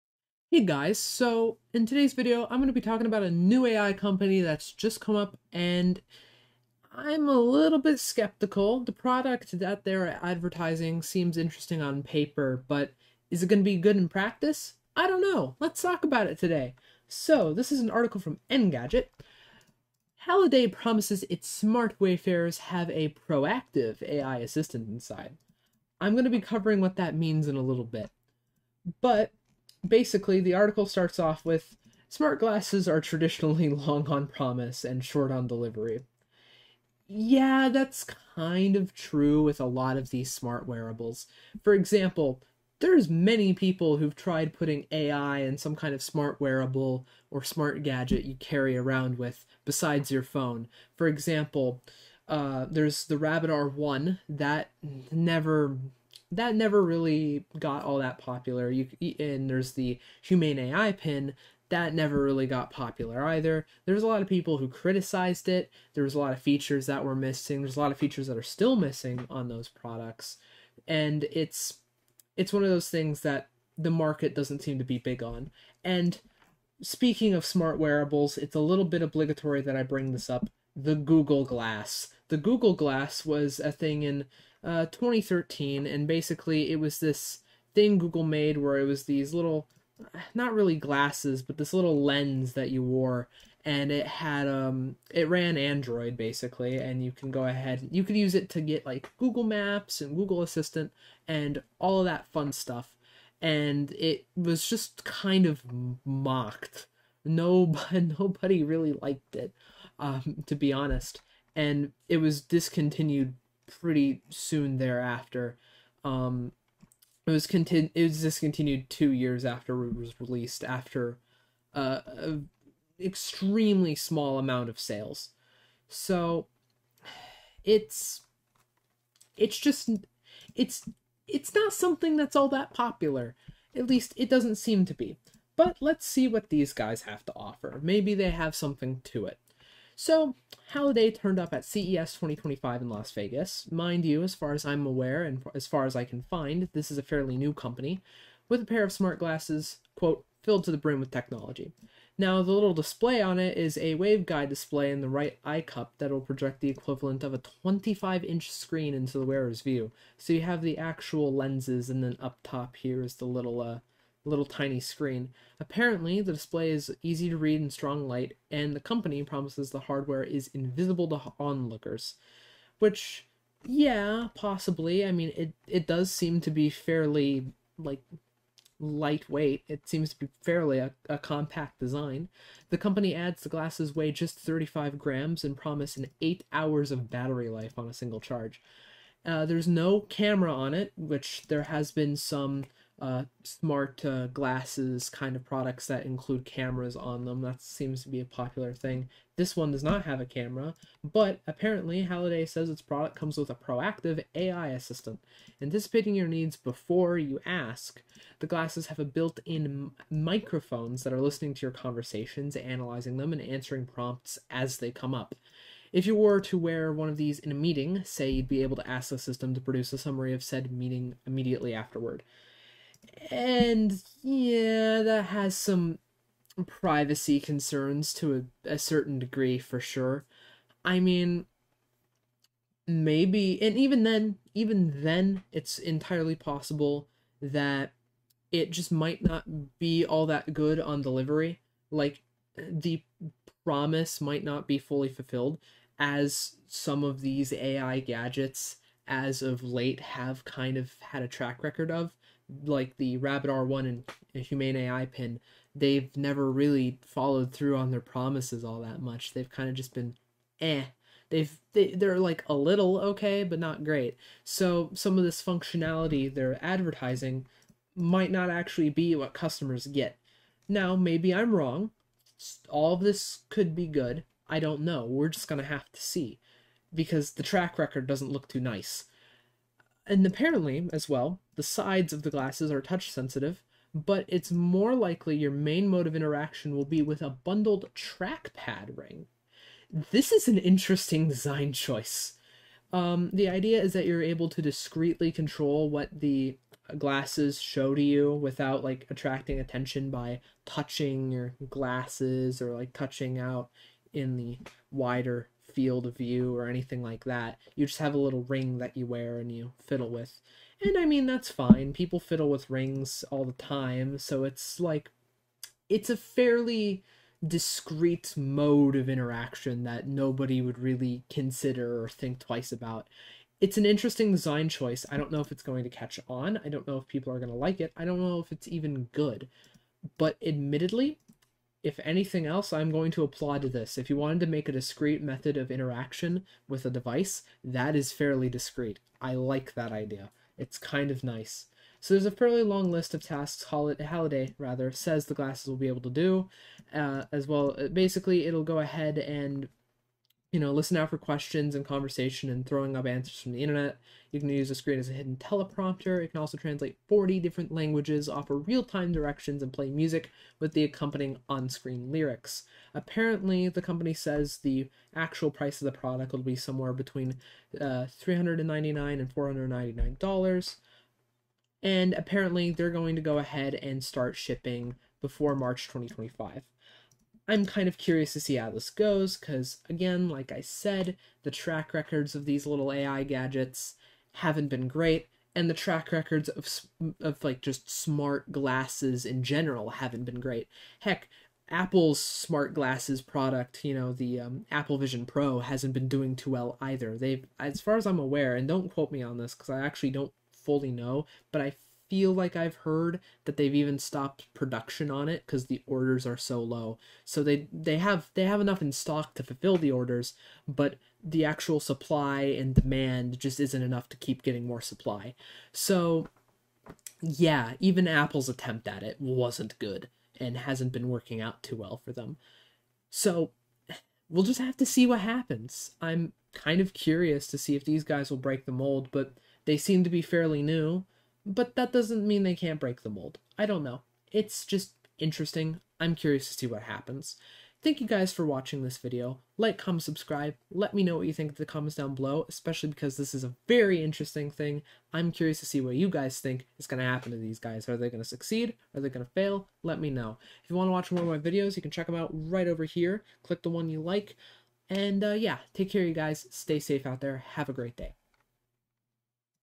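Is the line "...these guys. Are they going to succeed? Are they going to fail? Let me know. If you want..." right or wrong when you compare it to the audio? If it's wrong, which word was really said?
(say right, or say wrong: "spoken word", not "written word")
right.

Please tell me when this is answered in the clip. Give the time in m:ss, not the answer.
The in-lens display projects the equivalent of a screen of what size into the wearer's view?
2:37.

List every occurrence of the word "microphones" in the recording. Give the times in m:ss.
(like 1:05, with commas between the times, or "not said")
3:30.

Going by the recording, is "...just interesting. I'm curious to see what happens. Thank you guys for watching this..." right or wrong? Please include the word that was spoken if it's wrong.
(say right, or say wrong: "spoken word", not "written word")
right.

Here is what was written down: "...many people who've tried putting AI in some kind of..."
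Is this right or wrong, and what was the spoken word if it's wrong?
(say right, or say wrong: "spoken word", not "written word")
right.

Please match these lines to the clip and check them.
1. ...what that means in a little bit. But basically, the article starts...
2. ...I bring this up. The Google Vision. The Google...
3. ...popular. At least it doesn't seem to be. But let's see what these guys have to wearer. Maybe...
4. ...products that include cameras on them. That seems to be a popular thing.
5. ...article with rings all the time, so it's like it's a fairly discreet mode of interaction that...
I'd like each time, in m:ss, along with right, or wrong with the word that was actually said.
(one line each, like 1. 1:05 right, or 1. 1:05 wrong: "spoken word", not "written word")
1. 0:26 right
2. 1:19 wrong: "Glass", not "Vision"
3. 2:12 wrong: "offer", not "wearer"
4. 3:15 right
5. 5:12 wrong: "fiddle", not "article".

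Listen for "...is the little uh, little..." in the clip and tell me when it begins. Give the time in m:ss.
2:43.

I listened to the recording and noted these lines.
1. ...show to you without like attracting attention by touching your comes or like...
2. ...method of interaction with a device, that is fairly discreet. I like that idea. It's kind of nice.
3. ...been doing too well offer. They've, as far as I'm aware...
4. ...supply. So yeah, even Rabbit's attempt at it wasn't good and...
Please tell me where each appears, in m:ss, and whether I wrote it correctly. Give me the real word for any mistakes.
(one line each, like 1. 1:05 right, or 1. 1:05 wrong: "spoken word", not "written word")
1. 4:57 wrong: "glasses", not "comes"
2. 5:35 right
3. 6:35 wrong: "either", not "offer"
4. 6:54 wrong: "Apple", not "Rabbit".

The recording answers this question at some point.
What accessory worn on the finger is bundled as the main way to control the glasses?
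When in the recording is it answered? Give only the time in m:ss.
4:47.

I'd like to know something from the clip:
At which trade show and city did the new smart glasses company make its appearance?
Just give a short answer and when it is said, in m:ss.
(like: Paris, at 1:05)
CES 2025 in Las Vegas, at 2:21.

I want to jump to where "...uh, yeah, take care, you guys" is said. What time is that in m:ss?
7:35.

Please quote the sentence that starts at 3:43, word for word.
And yeah, that has some privacy concerns to a, a certain degree for sure.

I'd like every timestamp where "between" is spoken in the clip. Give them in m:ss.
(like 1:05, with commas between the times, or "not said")
6:06.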